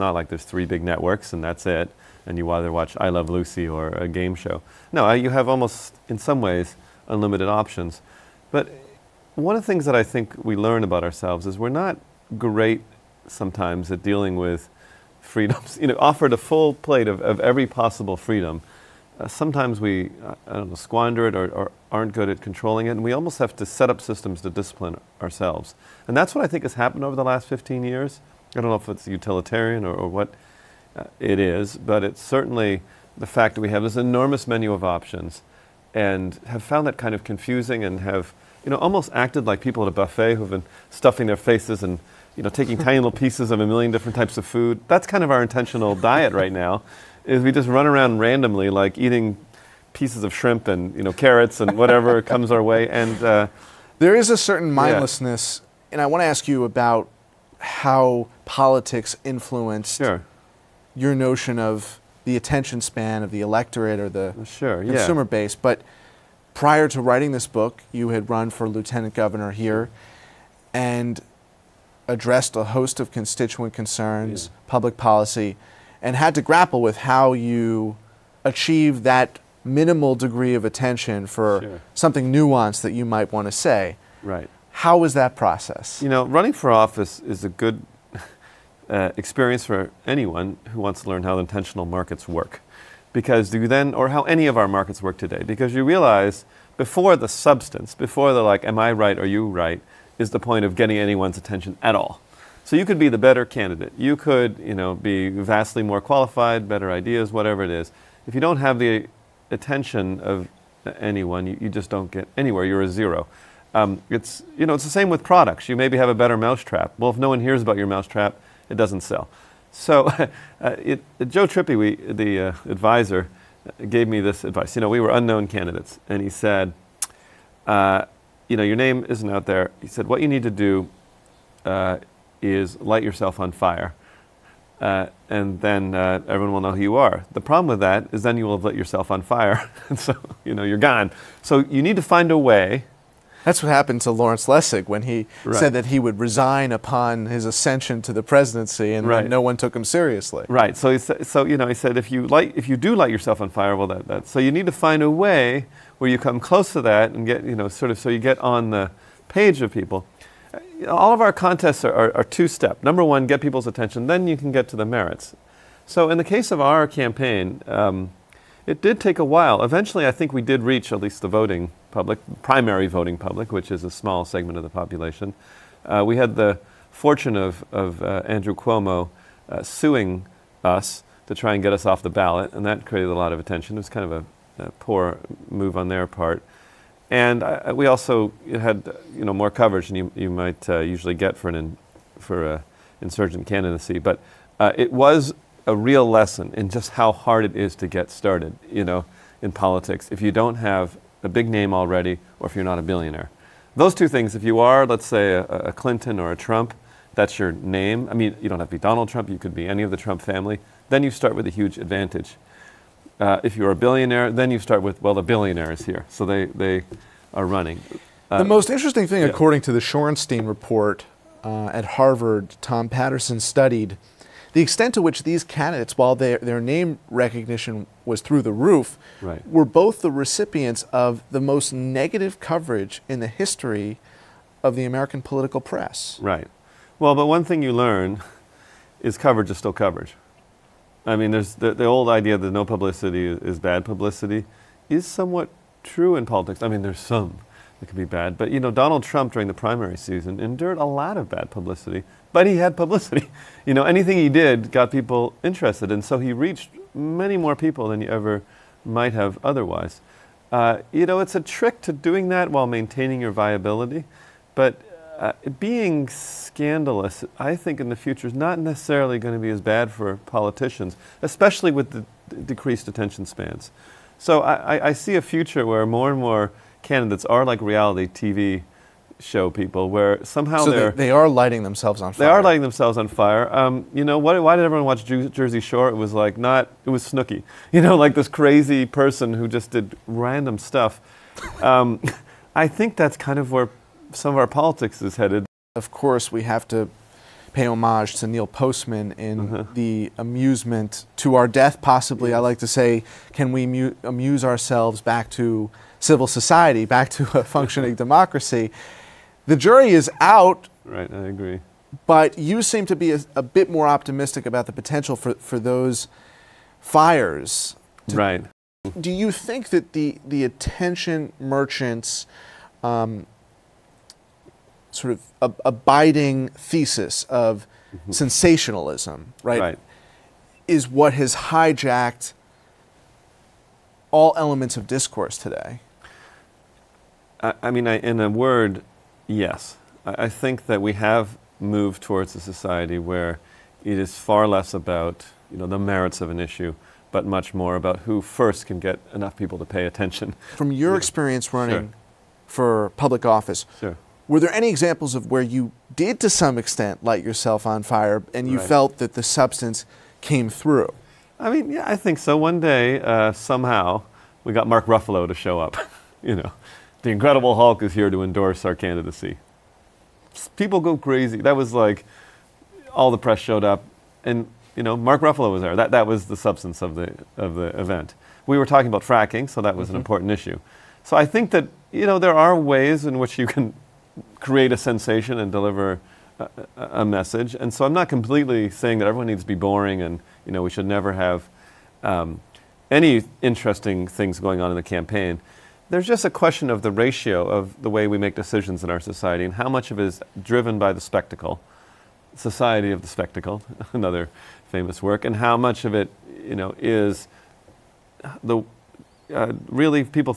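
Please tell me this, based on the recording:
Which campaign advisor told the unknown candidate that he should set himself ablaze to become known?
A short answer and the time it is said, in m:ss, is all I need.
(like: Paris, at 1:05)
Joe Trippi, at 2:01.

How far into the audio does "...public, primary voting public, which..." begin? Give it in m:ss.
2:51.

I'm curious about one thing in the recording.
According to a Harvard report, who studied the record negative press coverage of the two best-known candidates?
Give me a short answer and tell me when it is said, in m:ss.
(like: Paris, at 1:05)
Tom Patterson, at 3:42.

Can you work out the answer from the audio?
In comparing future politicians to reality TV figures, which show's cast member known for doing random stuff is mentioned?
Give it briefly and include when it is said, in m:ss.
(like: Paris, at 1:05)
Snooki, at 4:47.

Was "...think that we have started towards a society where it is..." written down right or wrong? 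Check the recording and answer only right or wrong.
wrong.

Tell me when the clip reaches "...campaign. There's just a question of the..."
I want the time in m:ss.
6:34.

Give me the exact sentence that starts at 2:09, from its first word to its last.
He said, what you need to do uh, is light yourself on fire.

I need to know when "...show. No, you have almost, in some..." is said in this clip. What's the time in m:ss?
0:04.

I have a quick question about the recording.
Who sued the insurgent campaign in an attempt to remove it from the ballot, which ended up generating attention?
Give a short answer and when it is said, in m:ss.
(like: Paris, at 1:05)
Andrew Cuomo, at 2:58.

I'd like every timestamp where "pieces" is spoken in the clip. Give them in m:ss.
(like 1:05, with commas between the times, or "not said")
0:43, 0:49.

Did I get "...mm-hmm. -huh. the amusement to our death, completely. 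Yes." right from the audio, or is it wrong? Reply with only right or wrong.
wrong.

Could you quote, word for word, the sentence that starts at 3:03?
It was kind of a, a poor move on their part.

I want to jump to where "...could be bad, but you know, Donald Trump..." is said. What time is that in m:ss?
4:07.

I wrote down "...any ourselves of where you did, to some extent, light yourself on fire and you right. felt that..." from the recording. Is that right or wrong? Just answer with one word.
wrong.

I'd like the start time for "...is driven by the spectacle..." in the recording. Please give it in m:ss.
6:40.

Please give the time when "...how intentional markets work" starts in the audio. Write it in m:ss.
1:31.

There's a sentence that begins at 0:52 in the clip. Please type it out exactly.
And uh, there is a certain mindlessness, yeah.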